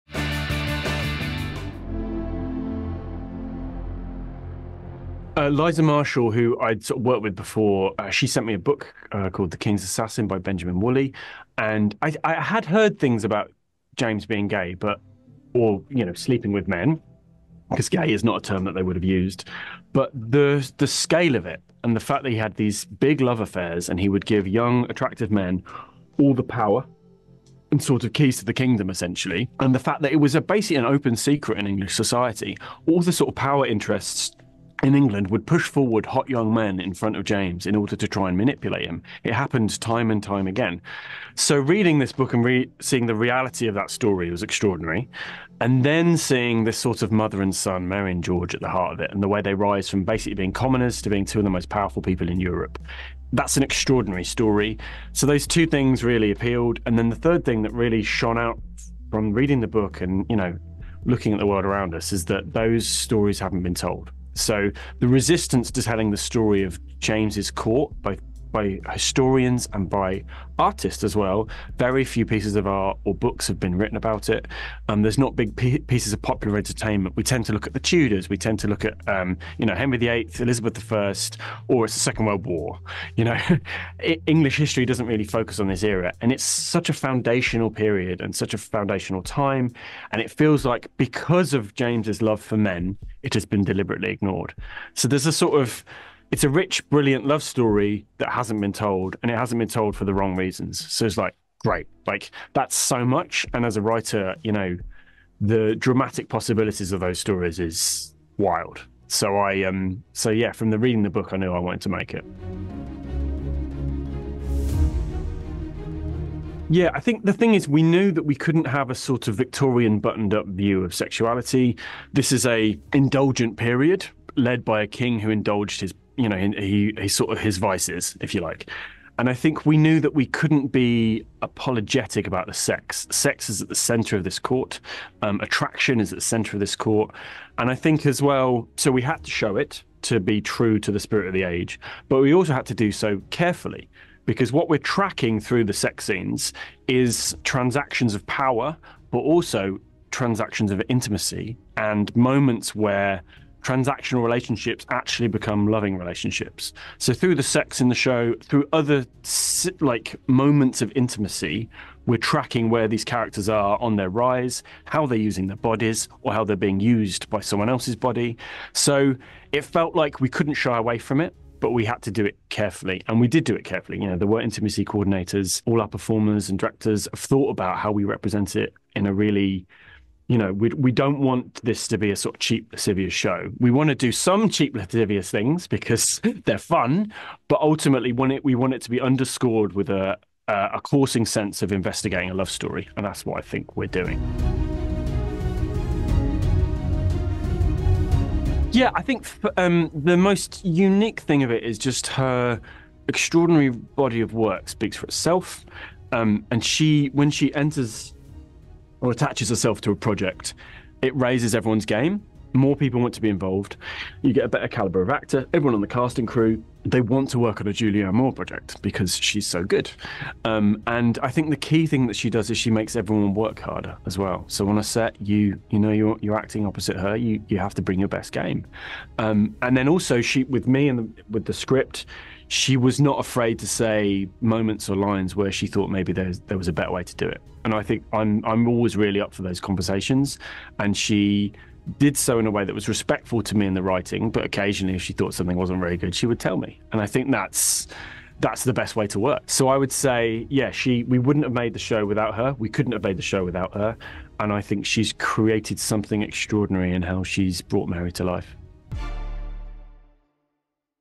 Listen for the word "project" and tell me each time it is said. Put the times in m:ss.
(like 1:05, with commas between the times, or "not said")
3:29, 3:38.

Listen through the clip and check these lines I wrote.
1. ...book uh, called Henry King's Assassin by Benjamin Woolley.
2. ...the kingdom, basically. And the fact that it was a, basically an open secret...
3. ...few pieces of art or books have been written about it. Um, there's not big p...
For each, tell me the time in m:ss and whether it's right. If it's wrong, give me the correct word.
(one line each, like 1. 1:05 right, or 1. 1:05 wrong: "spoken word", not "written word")
1. 0:08 wrong: "The", not "Henry"
2. 0:28 wrong: "essentially", not "basically"
3. 1:12 right.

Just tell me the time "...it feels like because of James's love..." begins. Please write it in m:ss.
1:30.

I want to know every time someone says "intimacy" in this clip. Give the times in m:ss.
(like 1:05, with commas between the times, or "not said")
2:30, 2:40, 2:54.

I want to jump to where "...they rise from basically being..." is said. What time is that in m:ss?
0:49.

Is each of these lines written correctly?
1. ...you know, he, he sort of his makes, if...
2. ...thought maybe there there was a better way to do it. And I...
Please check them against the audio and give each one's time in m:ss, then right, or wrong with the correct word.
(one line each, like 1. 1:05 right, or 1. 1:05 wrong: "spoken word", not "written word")
1. 2:06 wrong: "vices", not "makes"
2. 3:55 right.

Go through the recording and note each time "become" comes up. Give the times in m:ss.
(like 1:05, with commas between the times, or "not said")
2:35.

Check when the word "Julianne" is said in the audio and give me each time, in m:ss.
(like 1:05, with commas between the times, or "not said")
3:37.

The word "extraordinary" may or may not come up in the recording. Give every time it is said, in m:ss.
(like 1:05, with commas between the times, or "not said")
0:44, 0:53, 3:23, 4:16.